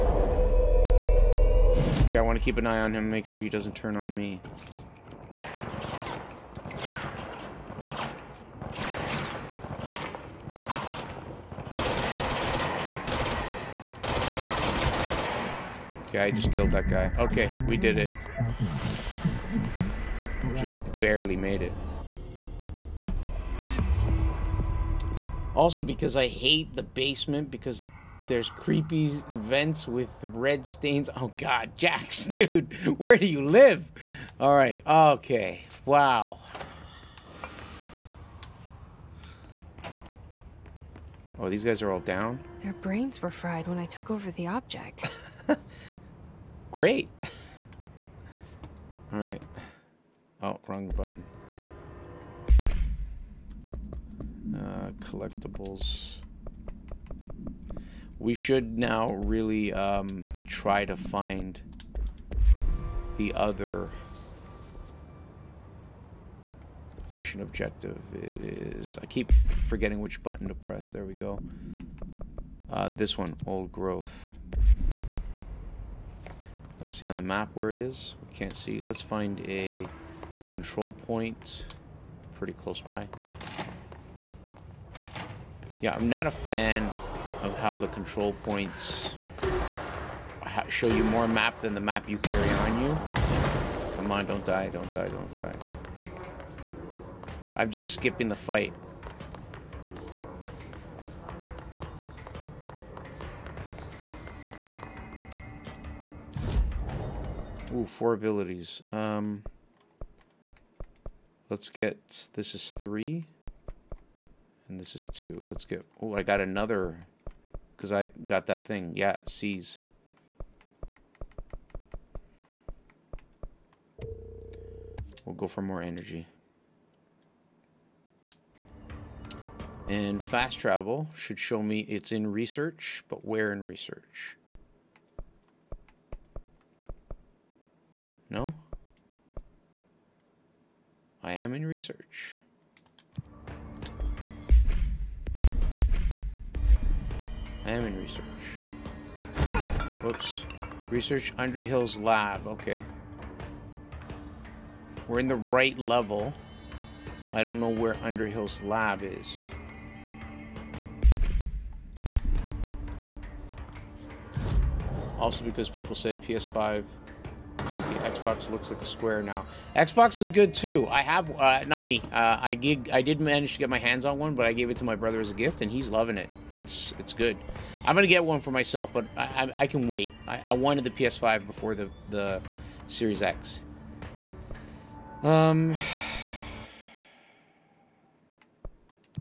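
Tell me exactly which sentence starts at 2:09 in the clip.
And fast travel should show me it's in research, but where in research?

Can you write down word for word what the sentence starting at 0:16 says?
Okay, I just killed that guy.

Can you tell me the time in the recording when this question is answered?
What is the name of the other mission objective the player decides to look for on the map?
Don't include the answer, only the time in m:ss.
1:13.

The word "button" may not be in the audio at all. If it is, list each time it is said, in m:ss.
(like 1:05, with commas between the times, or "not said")
0:50, 1:10.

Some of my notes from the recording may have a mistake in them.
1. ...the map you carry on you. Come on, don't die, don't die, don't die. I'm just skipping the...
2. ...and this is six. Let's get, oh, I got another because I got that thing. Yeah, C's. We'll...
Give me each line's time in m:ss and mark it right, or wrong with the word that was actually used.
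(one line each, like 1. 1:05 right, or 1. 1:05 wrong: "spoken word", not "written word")
1. 1:31 right
2. 1:54 wrong: "two", not "six".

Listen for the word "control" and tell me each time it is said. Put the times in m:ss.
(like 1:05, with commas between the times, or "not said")
1:20, 1:27.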